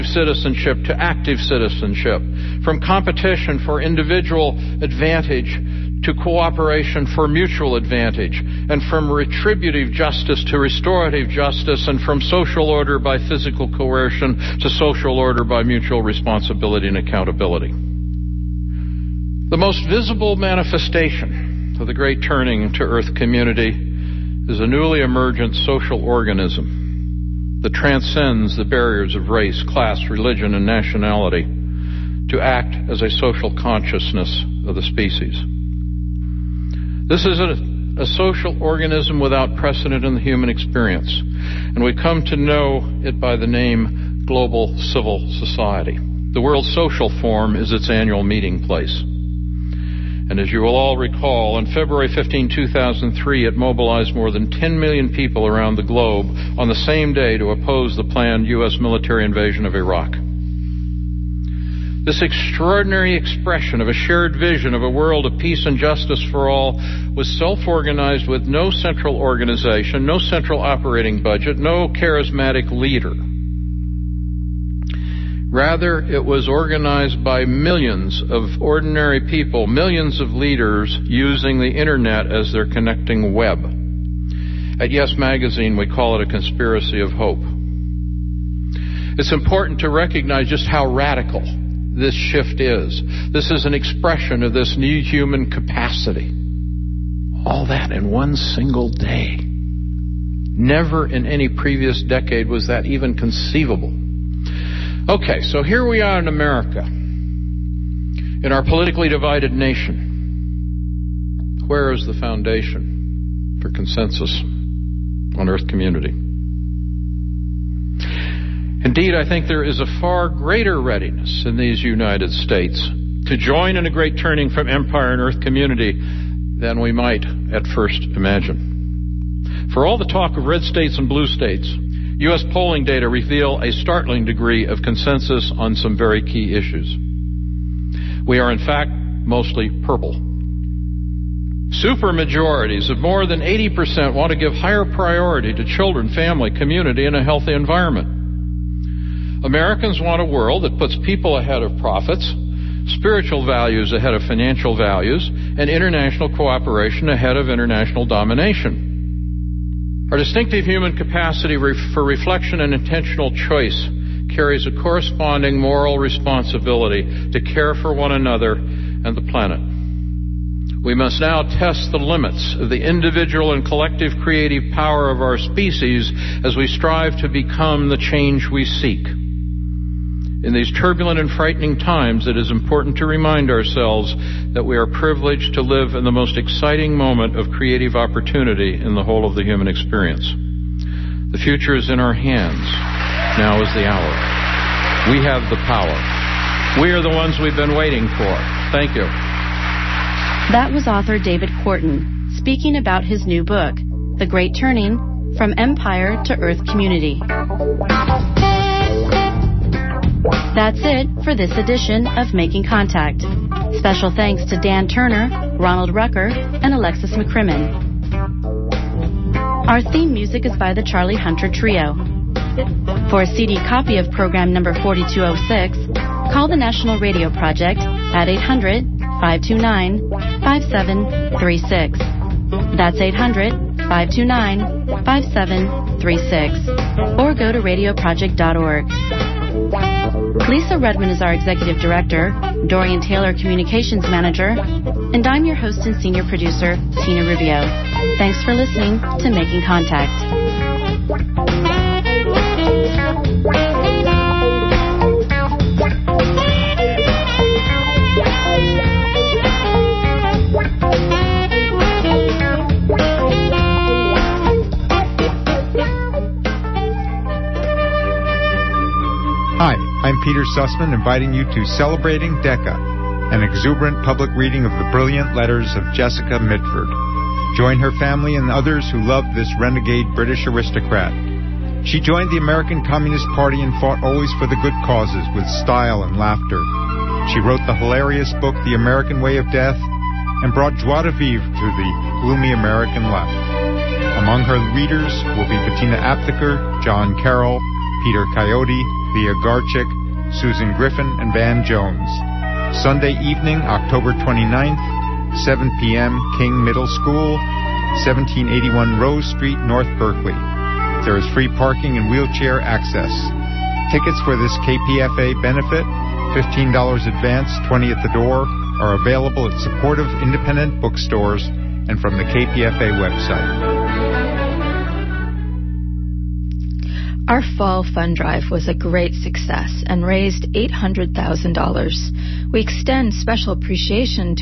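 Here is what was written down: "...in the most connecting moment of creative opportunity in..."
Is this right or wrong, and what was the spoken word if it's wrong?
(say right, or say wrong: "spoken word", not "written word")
wrong: "exciting", not "connecting".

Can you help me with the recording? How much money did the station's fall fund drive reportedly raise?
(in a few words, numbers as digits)
$800,000.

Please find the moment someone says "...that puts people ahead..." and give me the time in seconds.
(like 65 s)
150 s.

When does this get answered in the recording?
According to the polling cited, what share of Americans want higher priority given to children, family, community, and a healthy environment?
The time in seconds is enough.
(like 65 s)
142 s.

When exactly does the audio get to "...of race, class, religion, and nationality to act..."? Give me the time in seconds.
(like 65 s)
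29 s.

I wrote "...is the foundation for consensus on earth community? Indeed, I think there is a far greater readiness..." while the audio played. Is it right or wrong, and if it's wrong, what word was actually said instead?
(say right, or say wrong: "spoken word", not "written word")
right.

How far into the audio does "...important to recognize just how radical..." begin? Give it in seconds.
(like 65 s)
89 s.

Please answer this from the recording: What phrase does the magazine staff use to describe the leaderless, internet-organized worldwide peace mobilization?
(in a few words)
Conspiracy of hope.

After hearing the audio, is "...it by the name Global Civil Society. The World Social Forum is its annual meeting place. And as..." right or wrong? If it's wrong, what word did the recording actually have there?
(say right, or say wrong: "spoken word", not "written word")
right.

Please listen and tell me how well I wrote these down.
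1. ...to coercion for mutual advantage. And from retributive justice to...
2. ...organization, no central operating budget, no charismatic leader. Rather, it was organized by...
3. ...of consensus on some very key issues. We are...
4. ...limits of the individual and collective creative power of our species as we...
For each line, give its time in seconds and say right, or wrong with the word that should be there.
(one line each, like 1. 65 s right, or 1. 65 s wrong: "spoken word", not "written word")
1. 6 s wrong: "cooperation", not "coercion"
2. 69 s right
3. 134 s right
4. 171 s right.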